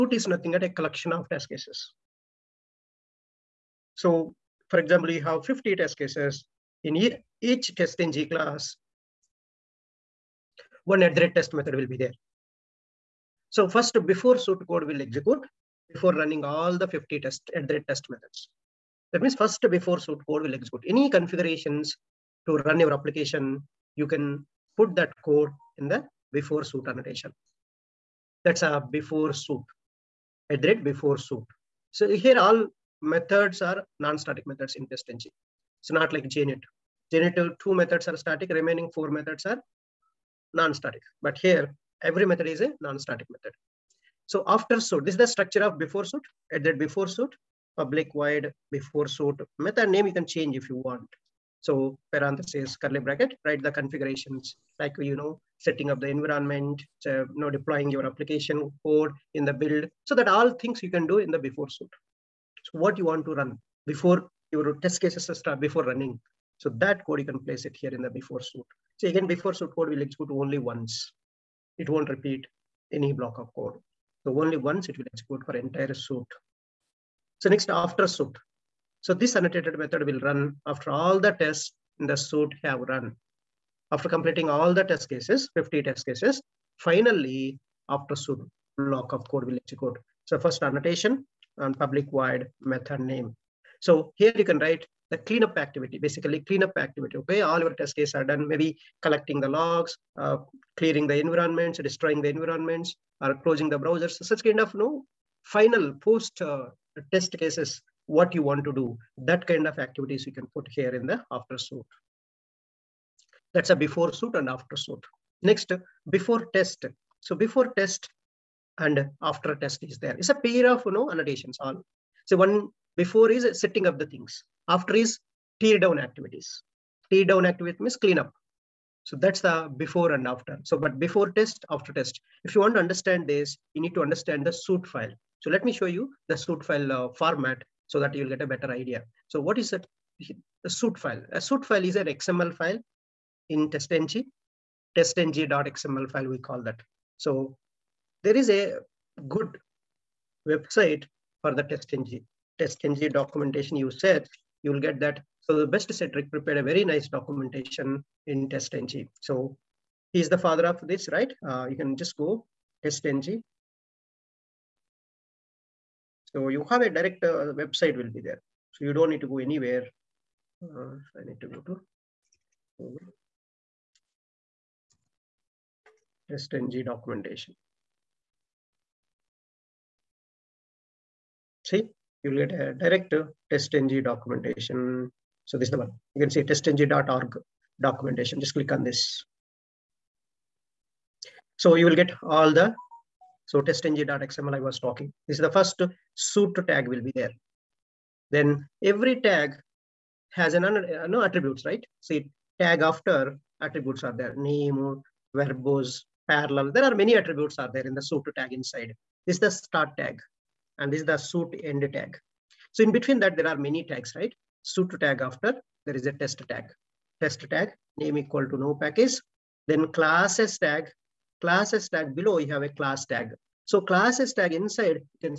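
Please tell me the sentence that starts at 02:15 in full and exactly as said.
So let me show you the suit file uh, format so that you will get a better idea.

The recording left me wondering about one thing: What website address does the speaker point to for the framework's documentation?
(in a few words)
testng.org.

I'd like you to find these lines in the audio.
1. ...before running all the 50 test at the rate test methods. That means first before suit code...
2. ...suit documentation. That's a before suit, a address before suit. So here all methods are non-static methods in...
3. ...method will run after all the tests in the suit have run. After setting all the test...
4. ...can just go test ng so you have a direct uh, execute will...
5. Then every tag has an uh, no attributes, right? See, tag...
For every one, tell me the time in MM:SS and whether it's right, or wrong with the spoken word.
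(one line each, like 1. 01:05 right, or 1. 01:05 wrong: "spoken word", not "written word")
1. 00:15 right
2. 00:26 wrong: "annotation", not "documentation"
3. 01:19 wrong: "completing", not "setting"
4. 02:41 wrong: "website", not "execute"
5. 03:18 right.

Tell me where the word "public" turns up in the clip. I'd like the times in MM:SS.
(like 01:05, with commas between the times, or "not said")
00:47, 01:31.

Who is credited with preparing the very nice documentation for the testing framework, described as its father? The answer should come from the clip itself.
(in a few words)
Cedric.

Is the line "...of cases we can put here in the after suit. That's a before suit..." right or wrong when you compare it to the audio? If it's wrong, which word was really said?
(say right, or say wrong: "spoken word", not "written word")
wrong: "activities", not "cases".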